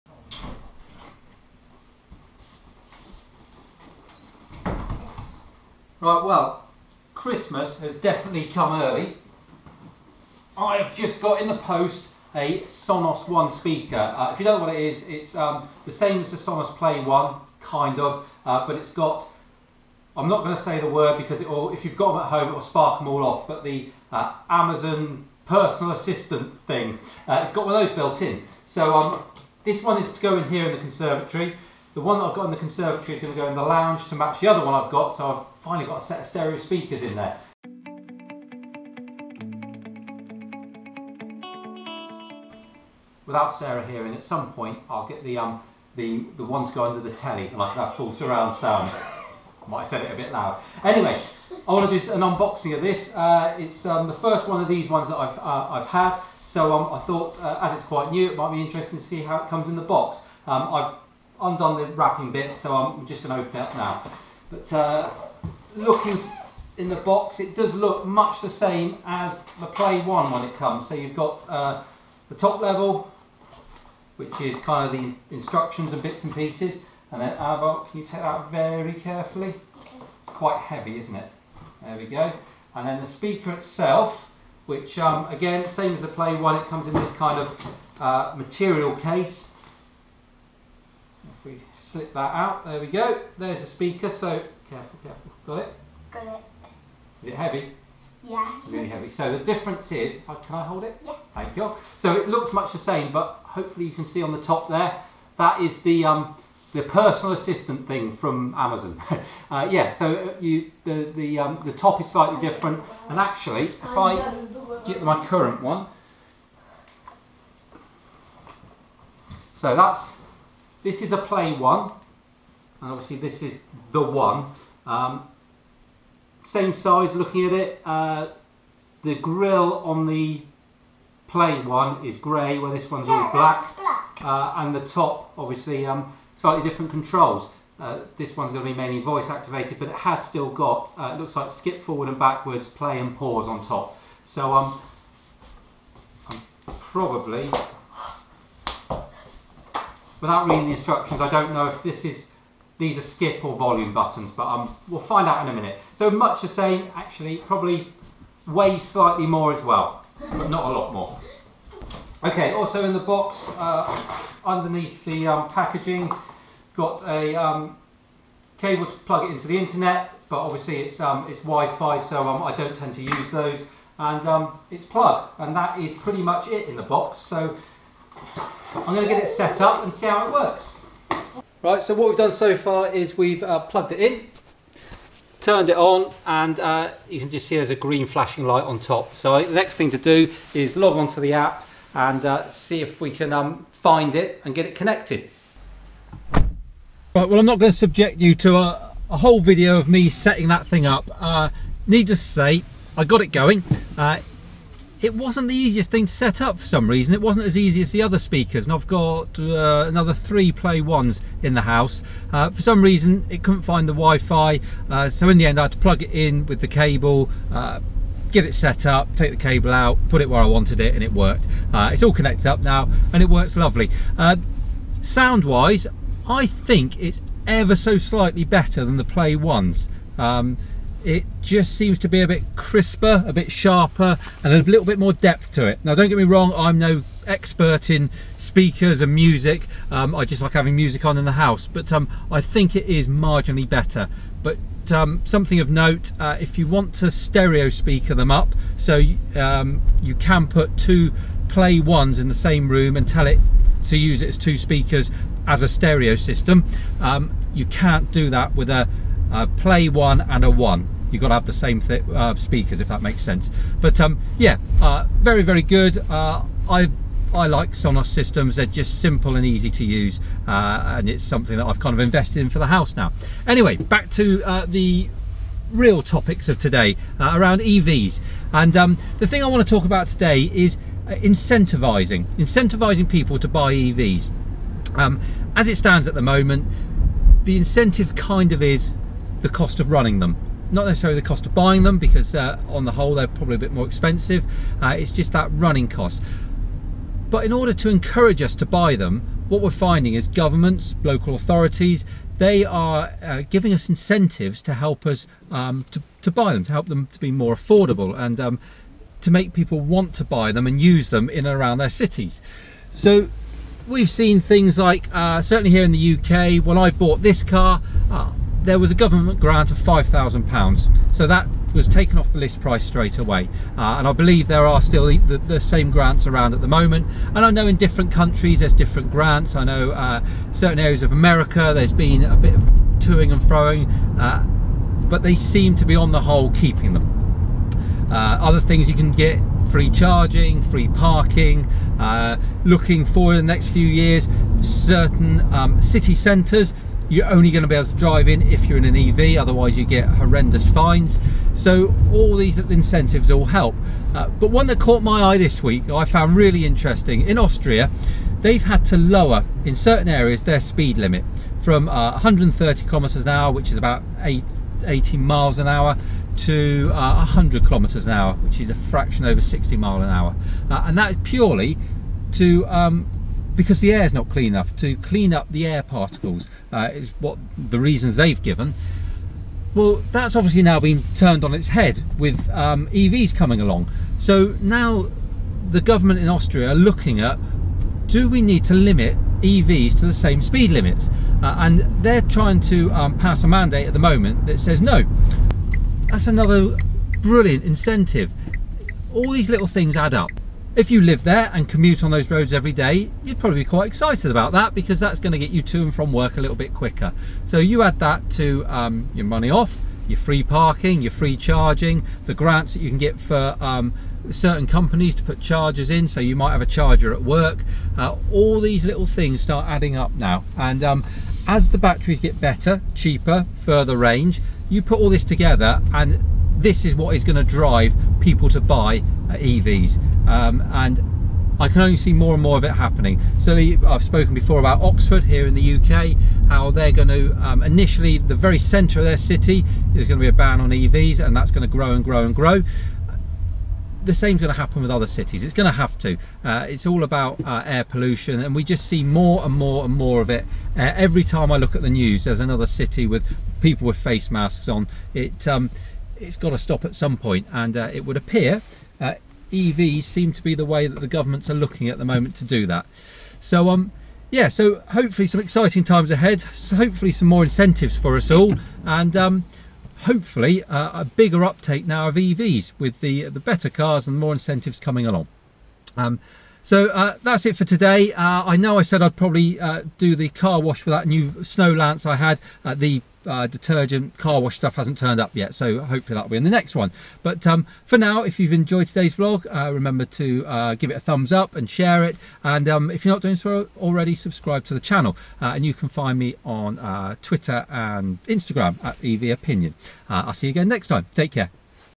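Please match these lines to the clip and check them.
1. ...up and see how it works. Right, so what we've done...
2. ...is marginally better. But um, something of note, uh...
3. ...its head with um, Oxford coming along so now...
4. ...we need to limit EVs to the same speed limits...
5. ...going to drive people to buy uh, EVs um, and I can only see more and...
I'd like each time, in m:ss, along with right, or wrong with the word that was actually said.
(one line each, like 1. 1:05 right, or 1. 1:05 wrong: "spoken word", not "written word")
1. 2:59 right
2. 4:02 right
3. 6:21 wrong: "EVs", not "Oxford"
4. 6:28 right
5. 7:07 right.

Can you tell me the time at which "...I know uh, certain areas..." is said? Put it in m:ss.
5:29.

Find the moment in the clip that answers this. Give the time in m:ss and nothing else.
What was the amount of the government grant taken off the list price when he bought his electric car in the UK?
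5:19.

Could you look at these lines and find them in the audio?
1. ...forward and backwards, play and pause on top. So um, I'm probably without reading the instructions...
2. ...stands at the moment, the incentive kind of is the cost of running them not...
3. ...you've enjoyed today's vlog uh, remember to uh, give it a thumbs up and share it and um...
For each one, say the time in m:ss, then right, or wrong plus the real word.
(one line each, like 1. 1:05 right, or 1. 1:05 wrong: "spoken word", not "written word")
1. 2:21 right
2. 4:45 right
3. 8:08 right.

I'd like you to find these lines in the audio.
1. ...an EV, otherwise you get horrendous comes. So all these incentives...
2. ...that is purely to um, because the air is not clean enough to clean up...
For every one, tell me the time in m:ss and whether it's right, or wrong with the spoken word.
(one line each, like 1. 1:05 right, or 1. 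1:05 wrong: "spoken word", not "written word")
1. 5:48 wrong: "fines", not "comes"
2. 6:10 right.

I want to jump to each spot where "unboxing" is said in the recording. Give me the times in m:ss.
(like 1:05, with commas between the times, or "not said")
0:52.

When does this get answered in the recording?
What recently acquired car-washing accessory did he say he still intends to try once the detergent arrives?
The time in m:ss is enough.
8:01.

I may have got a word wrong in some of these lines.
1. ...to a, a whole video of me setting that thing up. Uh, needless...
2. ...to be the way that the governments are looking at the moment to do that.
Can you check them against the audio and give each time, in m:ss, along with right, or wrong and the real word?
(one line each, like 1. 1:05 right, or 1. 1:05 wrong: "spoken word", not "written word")
1. 3:18 right
2. 7:40 right.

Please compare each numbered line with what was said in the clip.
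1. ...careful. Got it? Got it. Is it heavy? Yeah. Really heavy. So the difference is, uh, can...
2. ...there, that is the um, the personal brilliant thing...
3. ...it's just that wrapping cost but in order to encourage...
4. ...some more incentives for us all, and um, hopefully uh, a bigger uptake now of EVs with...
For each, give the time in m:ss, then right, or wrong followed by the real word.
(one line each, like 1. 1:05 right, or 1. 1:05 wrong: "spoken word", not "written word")
1. 1:35 right
2. 1:44 wrong: "assistant", not "brilliant"
3. 4:54 wrong: "running", not "wrapping"
4. 7:47 right.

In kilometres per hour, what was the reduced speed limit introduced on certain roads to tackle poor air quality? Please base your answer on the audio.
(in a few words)
100 km/h.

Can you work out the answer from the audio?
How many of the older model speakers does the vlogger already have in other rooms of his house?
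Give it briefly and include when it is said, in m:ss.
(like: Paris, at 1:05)
3, at 3:30.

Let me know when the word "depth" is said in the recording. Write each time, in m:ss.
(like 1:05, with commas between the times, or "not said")
3:55.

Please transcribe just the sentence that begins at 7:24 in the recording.
The same's going to happen with other cities.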